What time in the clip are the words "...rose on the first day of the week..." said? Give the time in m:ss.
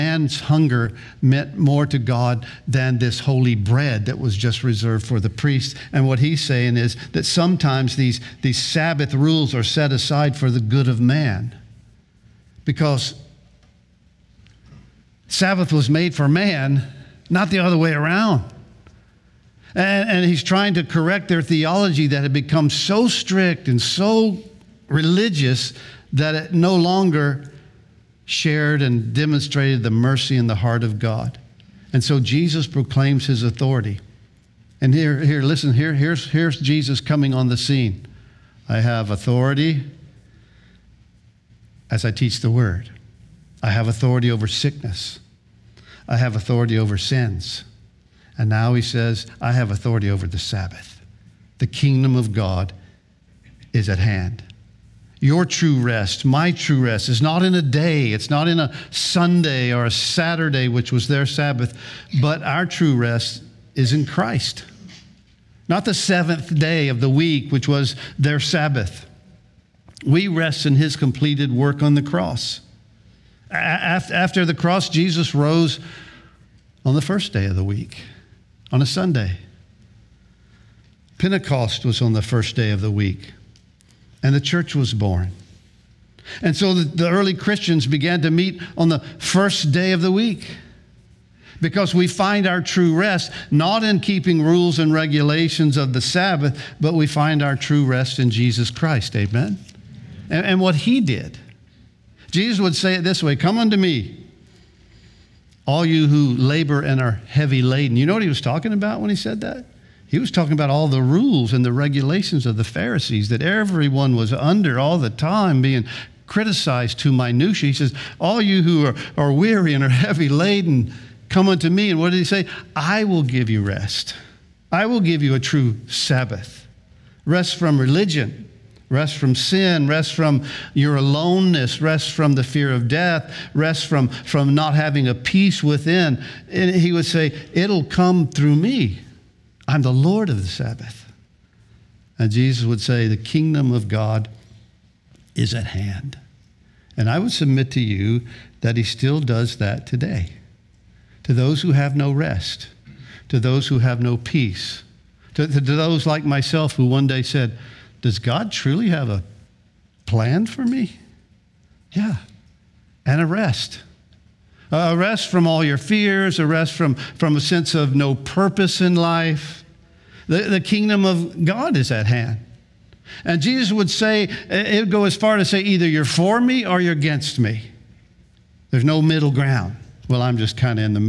1:15.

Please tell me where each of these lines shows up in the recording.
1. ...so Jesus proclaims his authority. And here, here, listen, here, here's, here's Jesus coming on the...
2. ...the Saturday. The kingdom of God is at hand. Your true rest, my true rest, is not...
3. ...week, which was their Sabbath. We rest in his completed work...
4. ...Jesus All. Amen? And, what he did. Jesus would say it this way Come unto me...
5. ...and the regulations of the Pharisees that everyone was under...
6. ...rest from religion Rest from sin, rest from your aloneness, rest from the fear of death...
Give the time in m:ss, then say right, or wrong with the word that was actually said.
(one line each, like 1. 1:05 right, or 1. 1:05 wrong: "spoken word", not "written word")
1. 0:32 right
2. 0:50 wrong: "Sabbath", not "Saturday"
3. 1:07 right
4. 1:38 wrong: "Christ", not "All"
5. 1:51 right
6. 2:07 right.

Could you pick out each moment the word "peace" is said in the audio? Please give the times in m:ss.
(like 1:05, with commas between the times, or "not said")
2:15, 2:34.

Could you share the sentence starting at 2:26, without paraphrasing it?
And I would submit to you that he still does that today.